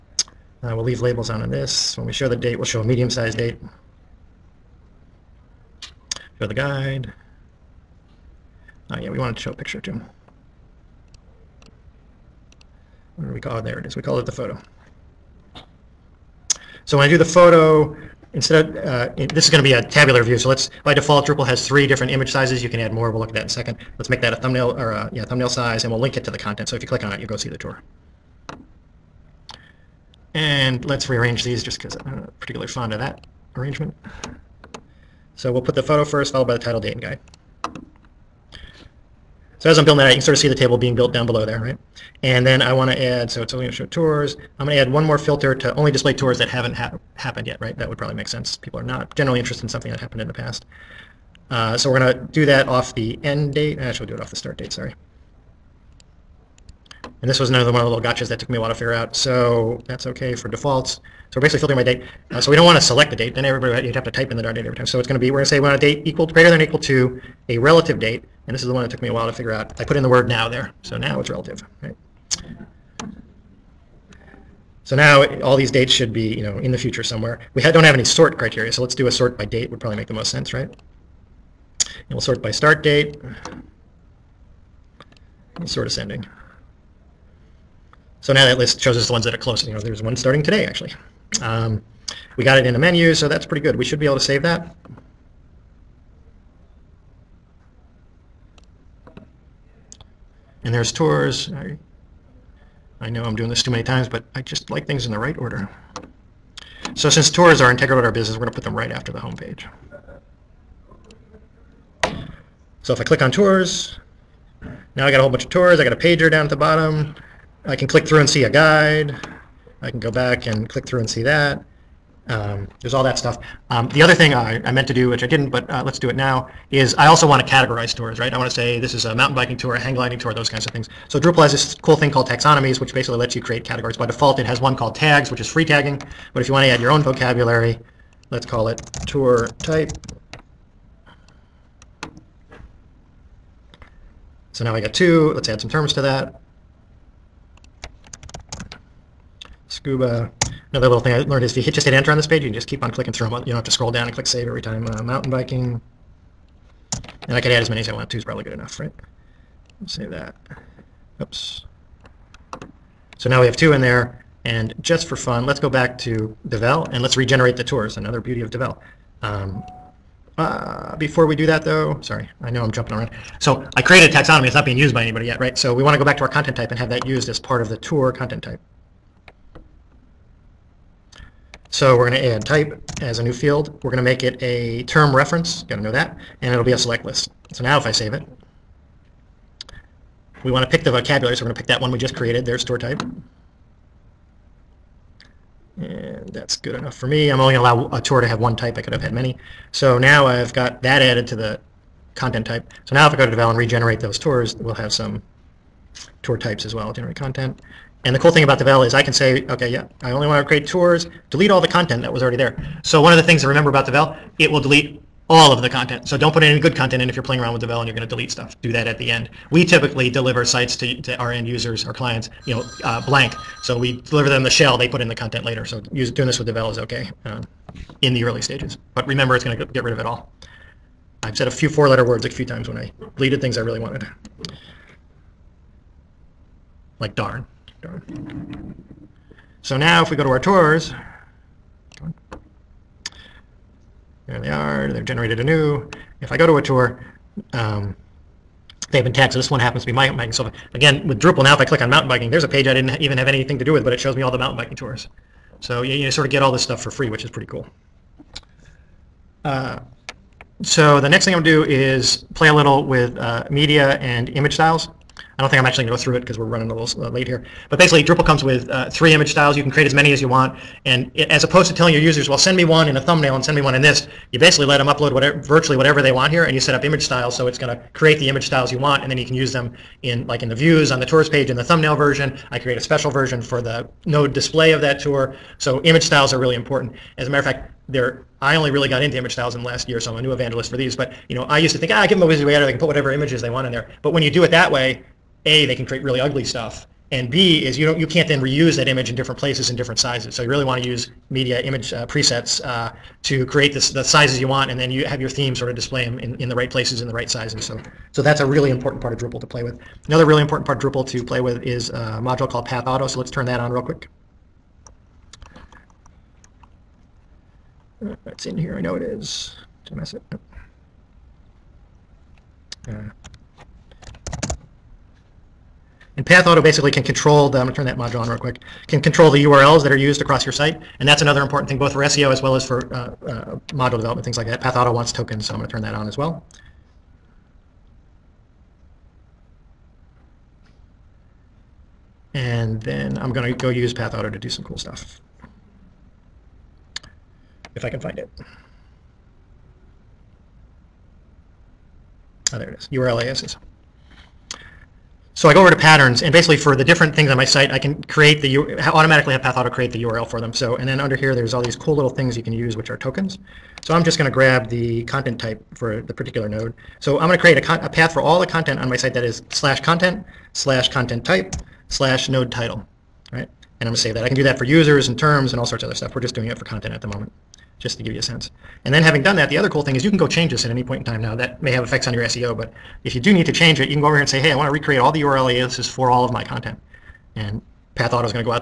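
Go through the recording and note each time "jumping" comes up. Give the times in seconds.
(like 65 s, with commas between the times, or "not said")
172 s.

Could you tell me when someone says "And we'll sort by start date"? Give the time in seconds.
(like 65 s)
81 s.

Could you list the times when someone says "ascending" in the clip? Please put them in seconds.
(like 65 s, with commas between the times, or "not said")
85 s.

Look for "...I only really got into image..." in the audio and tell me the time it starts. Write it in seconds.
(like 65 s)
288 s.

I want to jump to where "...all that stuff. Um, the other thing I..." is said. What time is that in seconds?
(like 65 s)
122 s.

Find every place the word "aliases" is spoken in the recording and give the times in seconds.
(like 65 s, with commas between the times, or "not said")
353 s, 385 s.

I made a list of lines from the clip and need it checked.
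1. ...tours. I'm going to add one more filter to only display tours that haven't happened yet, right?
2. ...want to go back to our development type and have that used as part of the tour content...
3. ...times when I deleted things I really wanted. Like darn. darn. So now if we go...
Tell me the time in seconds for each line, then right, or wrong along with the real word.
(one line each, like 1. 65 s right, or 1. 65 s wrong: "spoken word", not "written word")
1. 43 s right
2. 175 s wrong: "content", not "development"
3. 232 s right.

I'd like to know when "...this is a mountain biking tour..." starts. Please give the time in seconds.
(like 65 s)
128 s.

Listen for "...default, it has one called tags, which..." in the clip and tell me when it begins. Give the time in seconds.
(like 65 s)
134 s.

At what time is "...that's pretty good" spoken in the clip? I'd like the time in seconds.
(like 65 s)
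93 s.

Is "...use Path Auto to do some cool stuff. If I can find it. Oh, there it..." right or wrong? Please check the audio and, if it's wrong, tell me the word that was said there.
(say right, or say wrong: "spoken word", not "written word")
right.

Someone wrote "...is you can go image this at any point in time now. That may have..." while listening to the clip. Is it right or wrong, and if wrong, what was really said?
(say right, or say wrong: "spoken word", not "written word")
wrong: "change", not "image".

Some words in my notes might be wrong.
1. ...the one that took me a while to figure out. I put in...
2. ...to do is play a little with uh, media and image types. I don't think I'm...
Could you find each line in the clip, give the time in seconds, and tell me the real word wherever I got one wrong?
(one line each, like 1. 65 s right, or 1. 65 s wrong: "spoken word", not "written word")
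1. 68 s right
2. 261 s wrong: "styles", not "types".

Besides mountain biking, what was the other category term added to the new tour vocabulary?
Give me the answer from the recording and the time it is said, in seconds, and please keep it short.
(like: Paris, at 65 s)
Scuba, at 149 s.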